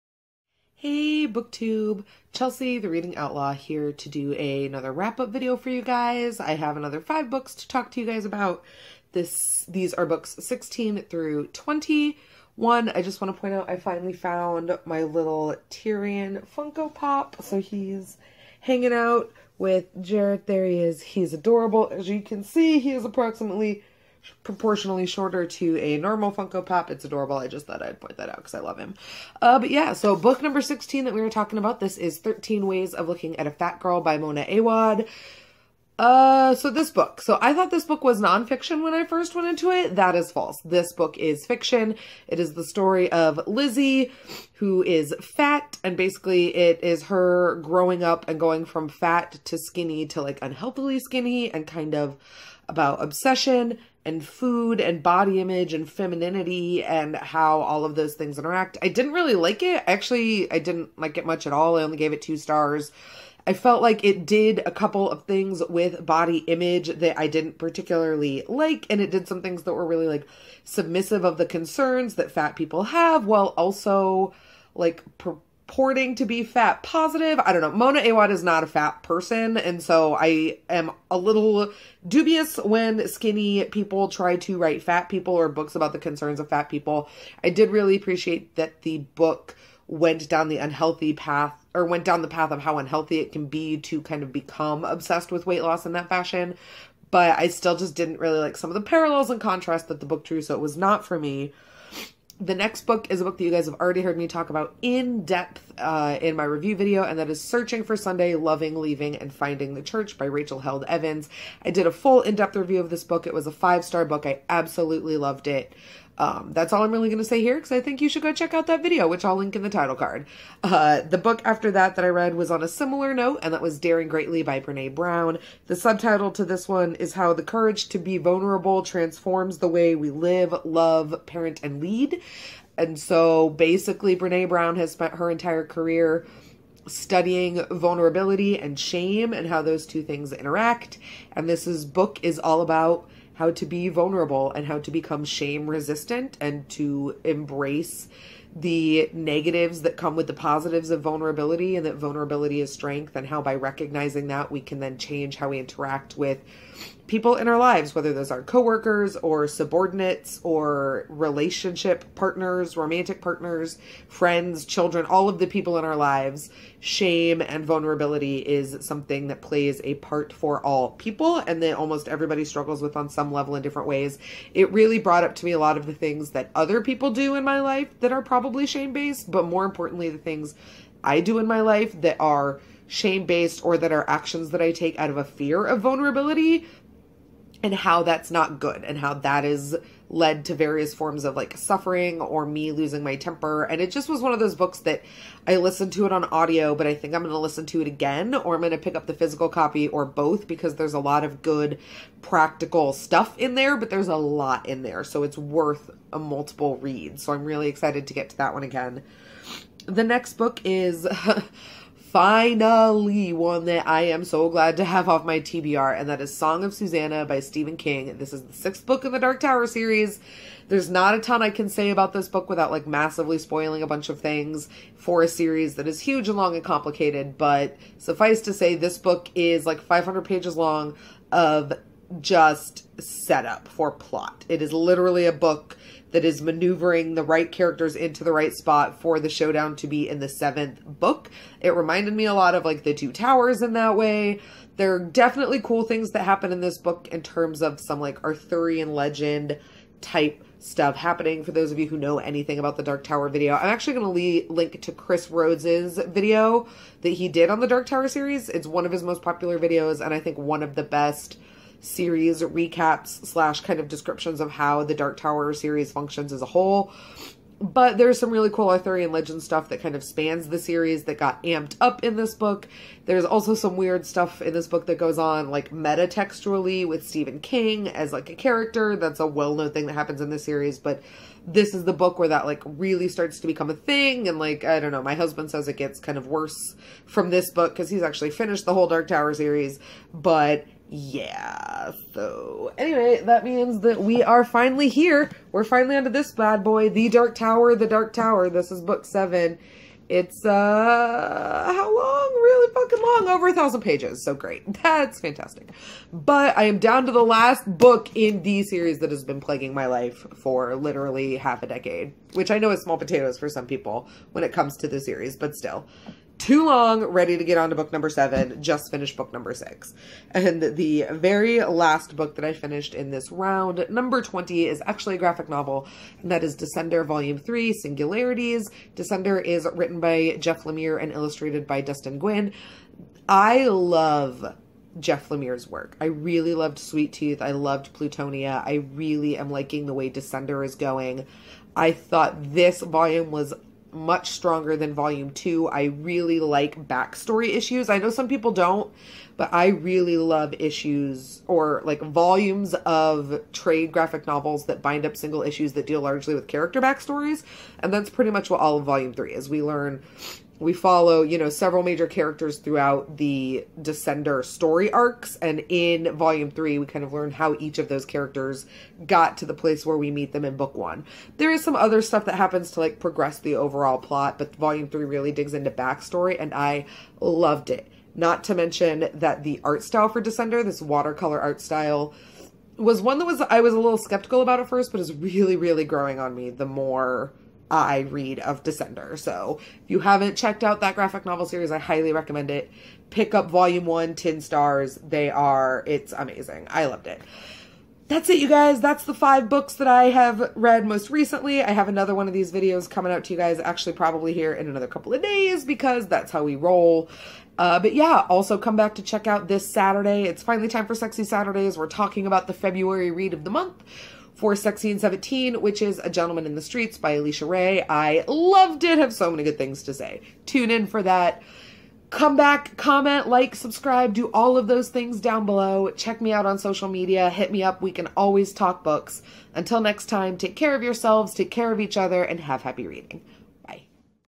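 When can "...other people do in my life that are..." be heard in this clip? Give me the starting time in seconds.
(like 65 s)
176 s.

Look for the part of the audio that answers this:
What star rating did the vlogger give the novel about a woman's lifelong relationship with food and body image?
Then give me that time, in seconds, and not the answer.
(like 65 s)
62 s.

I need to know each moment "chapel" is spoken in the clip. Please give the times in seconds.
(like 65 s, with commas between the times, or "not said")
not said.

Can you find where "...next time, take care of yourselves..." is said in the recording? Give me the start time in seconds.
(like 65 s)
429 s.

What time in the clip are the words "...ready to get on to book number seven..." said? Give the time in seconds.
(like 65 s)
317 s.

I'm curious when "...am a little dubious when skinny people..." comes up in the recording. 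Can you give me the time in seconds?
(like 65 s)
80 s.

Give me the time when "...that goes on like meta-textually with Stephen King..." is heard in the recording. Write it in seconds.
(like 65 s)
274 s.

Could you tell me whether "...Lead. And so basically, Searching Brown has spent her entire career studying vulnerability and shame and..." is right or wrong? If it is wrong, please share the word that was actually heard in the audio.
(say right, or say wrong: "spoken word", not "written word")
wrong: "Brene", not "Searching".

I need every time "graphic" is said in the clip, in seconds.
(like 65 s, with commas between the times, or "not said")
325 s, 353 s, 390 s.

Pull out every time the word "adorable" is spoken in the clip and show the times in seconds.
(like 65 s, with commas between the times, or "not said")
21 s, 27 s.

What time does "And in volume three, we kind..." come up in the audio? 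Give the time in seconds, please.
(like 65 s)
365 s.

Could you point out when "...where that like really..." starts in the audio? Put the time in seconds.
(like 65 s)
282 s.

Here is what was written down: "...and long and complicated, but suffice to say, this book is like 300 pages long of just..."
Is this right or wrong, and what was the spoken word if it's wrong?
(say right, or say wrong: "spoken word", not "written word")
wrong: "500", not "300".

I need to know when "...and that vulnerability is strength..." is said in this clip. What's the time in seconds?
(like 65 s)
151 s.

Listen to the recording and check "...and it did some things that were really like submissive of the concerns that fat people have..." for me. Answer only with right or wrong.
right.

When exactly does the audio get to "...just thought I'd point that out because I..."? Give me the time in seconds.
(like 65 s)
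27 s.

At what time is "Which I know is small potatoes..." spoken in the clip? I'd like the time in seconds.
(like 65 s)
312 s.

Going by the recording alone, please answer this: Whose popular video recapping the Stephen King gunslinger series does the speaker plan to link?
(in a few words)
Chris Rhodes.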